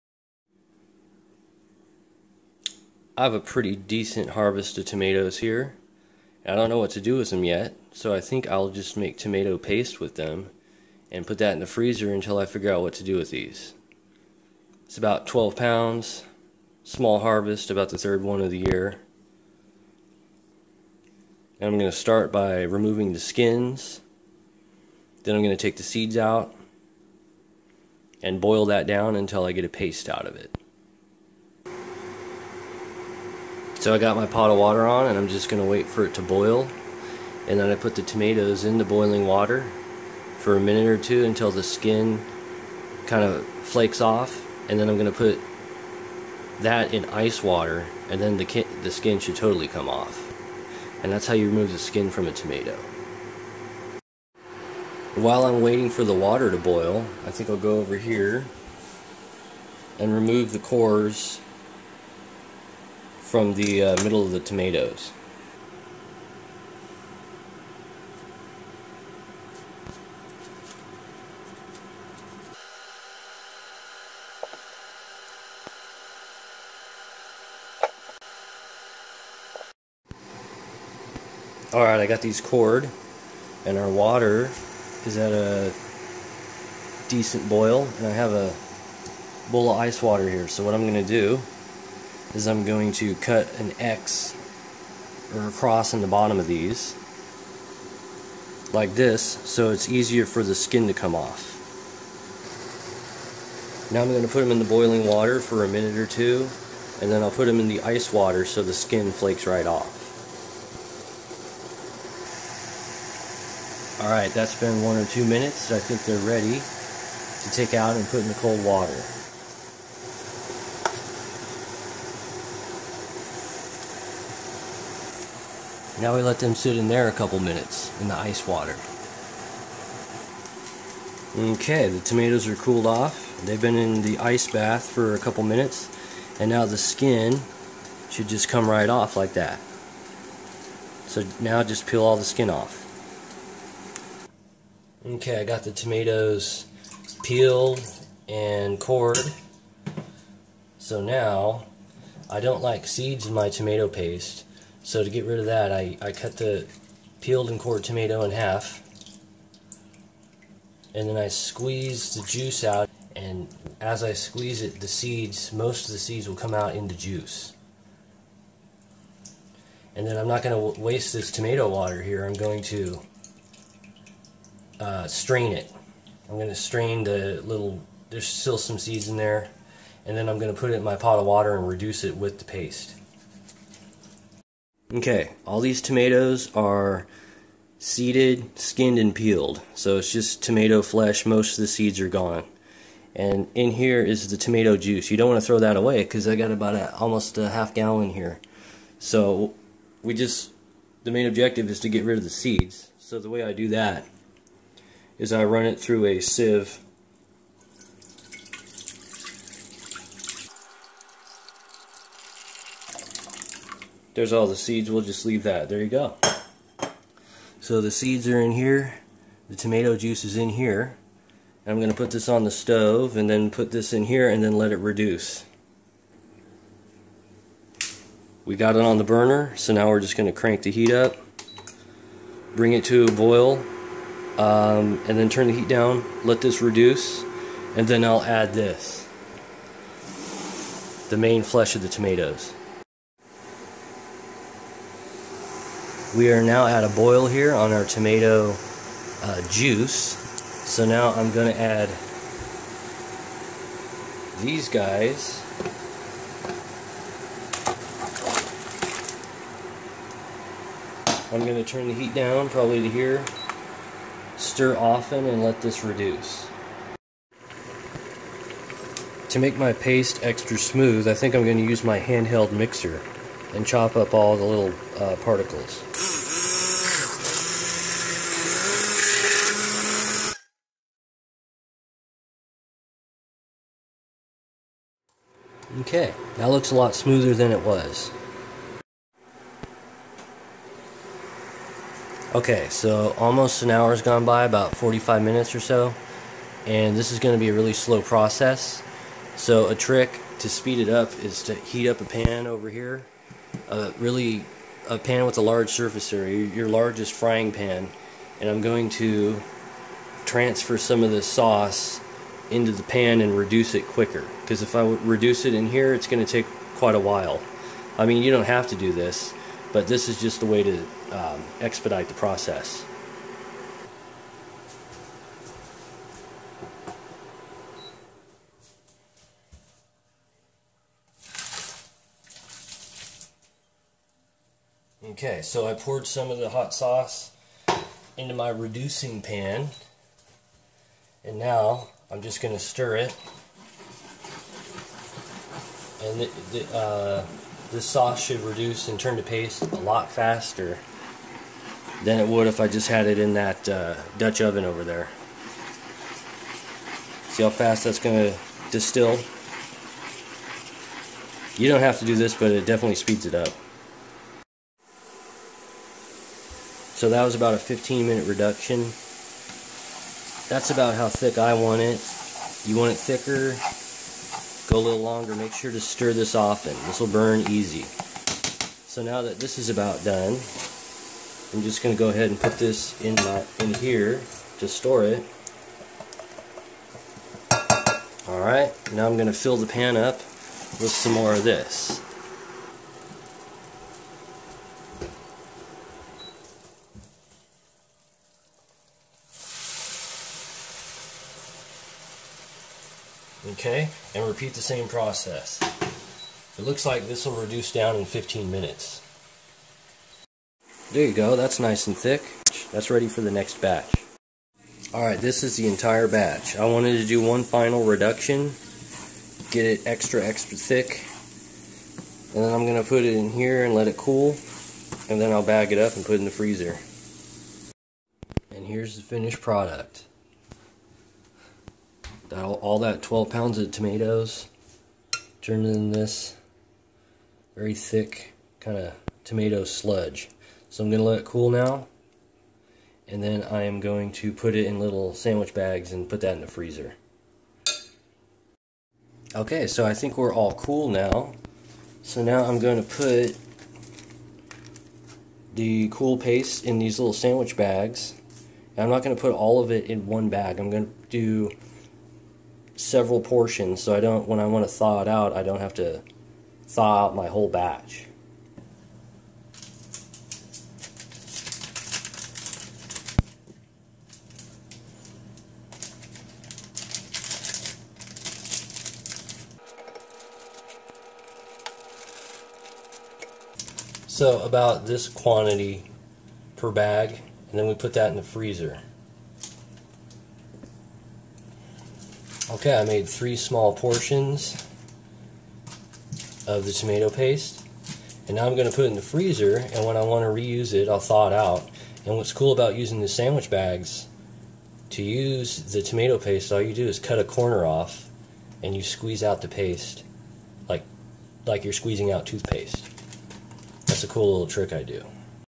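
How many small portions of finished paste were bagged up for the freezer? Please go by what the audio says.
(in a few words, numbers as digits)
3.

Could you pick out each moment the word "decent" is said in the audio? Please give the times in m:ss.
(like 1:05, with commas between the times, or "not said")
0:03, 1:27.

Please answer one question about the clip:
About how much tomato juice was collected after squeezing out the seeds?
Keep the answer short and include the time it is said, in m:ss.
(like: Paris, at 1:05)
almost a half gallon, at 3:16.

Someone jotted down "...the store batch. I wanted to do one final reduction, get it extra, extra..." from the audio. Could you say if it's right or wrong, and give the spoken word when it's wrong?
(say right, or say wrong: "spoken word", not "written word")
wrong: "entire", not "store".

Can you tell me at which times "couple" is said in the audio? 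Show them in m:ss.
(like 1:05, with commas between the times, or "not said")
2:07, 2:15.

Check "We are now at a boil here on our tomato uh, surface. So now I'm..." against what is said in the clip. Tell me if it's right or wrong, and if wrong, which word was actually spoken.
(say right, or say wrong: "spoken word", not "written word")
wrong: "juice", not "surface".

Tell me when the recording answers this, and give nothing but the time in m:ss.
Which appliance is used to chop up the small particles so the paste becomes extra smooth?
4:32.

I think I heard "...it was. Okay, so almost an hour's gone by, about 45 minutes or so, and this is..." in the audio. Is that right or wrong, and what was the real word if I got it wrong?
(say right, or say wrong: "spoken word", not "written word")
right.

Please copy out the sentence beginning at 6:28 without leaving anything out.
Alright, now I'm going to fill the pan up with some more of this.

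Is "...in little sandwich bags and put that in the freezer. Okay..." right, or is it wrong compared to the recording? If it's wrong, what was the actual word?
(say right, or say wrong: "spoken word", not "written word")
right.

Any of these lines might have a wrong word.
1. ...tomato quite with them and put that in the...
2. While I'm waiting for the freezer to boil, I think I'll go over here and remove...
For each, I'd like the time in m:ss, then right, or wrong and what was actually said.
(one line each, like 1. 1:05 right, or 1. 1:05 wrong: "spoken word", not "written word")
1. 0:09 wrong: "paste", not "quite"
2. 0:55 wrong: "water", not "freezer".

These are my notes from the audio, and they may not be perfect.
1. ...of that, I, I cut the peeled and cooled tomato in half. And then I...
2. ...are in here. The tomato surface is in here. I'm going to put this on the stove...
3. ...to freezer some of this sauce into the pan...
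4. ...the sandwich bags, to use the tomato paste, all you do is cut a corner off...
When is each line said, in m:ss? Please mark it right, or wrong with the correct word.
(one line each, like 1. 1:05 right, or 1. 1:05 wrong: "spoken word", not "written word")
1. 2:35 wrong: "cored", not "cooled"
2. 3:38 wrong: "juice", not "surface"
3. 5:08 wrong: "transfer", not "freezer"
4. 8:22 right.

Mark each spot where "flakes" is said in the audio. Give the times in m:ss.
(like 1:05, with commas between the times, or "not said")
0:43, 1:49.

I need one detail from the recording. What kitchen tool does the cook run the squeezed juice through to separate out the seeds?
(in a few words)
a sieve.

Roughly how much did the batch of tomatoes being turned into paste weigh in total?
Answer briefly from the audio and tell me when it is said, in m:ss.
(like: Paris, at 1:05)
12 pounds, at 0:14.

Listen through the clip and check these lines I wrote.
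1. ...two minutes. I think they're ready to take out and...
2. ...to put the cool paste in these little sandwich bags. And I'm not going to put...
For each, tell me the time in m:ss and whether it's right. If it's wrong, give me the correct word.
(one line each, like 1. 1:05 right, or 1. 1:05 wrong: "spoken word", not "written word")
1. 1:55 right
2. 7:32 right.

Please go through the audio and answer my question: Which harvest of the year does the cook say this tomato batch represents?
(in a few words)
the third.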